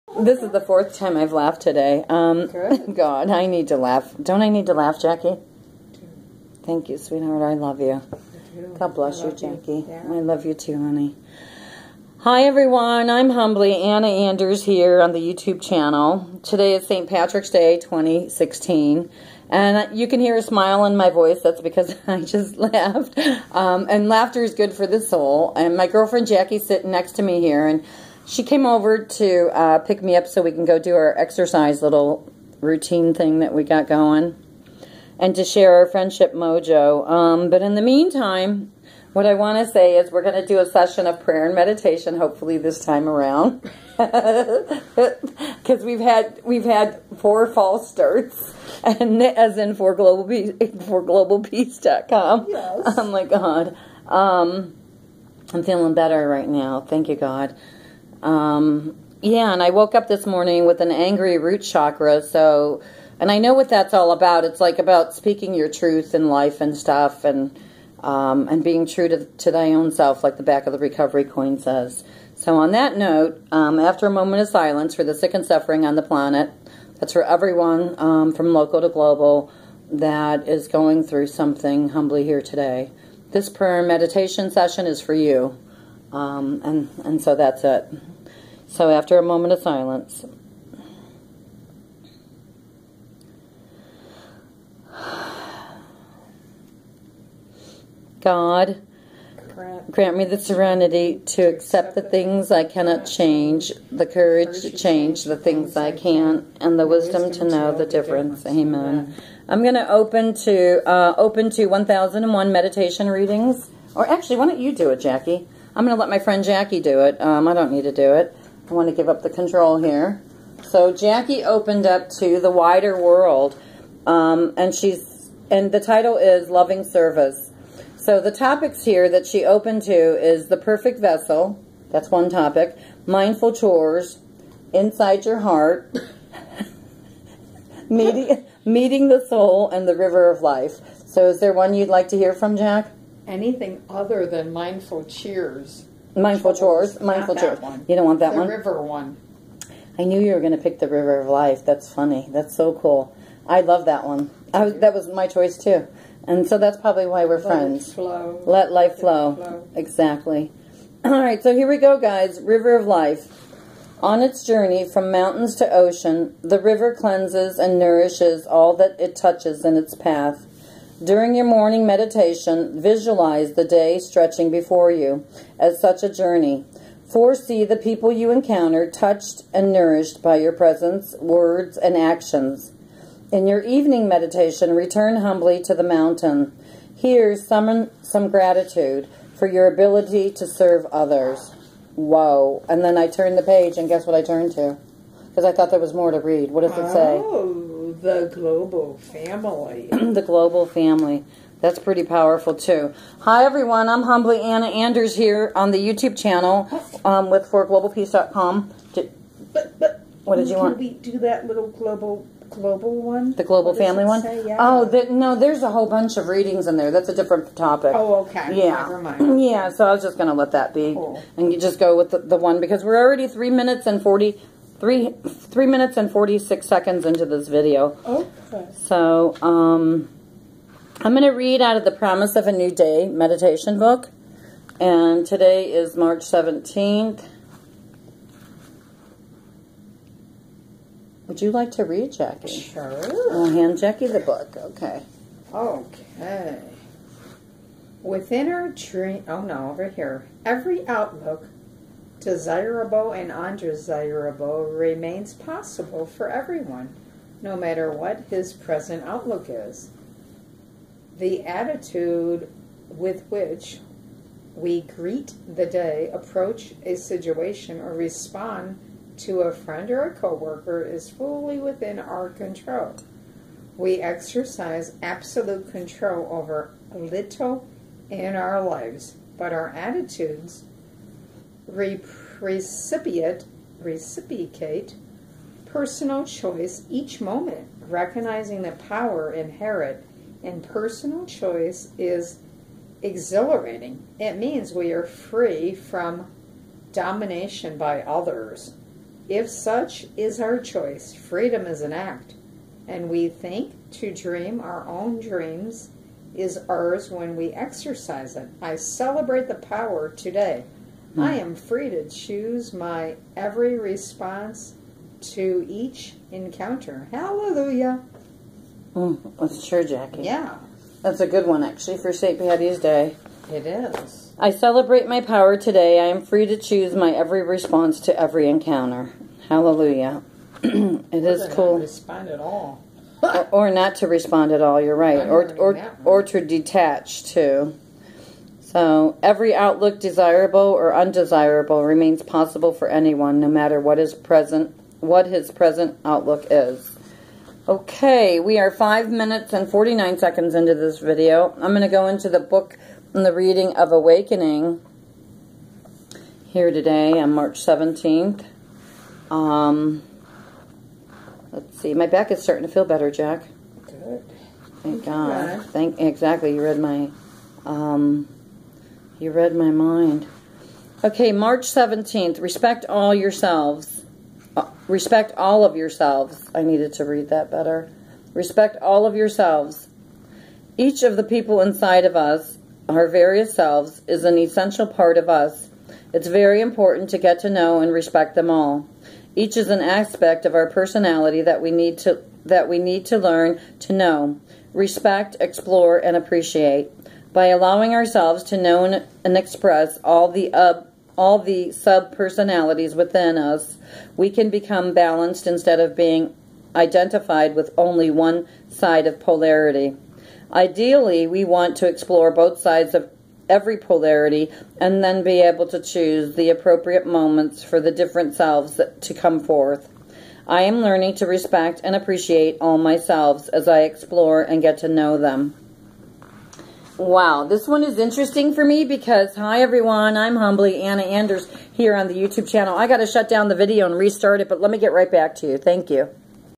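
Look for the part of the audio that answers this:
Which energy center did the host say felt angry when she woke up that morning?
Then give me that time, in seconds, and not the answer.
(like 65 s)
61 s.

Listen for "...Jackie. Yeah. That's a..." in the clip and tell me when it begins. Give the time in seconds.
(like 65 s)
319 s.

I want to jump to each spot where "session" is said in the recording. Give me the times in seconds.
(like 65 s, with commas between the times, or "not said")
40 s, 84 s.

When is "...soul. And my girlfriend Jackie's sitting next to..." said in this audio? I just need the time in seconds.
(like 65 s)
25 s.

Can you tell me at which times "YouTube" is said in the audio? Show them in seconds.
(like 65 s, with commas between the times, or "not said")
15 s, 205 s, 432 s.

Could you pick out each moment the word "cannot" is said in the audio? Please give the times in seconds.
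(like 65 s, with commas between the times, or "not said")
102 s.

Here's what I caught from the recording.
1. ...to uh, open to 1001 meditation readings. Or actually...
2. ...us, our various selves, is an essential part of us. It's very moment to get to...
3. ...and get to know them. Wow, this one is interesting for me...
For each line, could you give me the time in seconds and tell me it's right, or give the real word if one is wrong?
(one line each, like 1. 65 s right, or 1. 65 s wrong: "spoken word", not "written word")
1. 110 s right
2. 382 s wrong: "important", not "moment"
3. 424 s right.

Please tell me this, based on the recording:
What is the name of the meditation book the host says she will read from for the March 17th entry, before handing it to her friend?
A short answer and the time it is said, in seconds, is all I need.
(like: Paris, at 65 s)
Promise of a New Day, at 231 s.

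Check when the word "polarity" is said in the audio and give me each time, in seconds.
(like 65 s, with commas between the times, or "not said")
409 s, 413 s.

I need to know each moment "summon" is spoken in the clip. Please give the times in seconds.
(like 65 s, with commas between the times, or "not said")
187 s.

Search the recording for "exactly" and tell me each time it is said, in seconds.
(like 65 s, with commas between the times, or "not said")
159 s, 365 s.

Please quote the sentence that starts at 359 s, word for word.
Um, let's see, my back is starting to feel better, Jack.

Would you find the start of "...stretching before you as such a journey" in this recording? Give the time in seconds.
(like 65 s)
173 s.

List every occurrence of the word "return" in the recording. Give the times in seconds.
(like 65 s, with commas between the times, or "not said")
184 s.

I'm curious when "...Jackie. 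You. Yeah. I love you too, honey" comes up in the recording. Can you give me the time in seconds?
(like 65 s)
9 s.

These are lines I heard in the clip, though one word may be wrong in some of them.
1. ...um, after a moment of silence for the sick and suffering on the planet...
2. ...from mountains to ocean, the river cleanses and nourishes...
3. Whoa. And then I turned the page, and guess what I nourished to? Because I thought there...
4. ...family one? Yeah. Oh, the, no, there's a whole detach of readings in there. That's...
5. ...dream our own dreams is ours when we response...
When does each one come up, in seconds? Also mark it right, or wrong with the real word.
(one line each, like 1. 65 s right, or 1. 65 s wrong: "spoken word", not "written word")
1. 73 s right
2. 164 s right
3. 191 s wrong: "turned", not "nourished"
4. 213 s wrong: "bunch", not "detach"
5. 304 s wrong: "exercise", not "response".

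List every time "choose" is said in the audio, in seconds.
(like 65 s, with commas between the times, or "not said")
312 s, 326 s, 415 s.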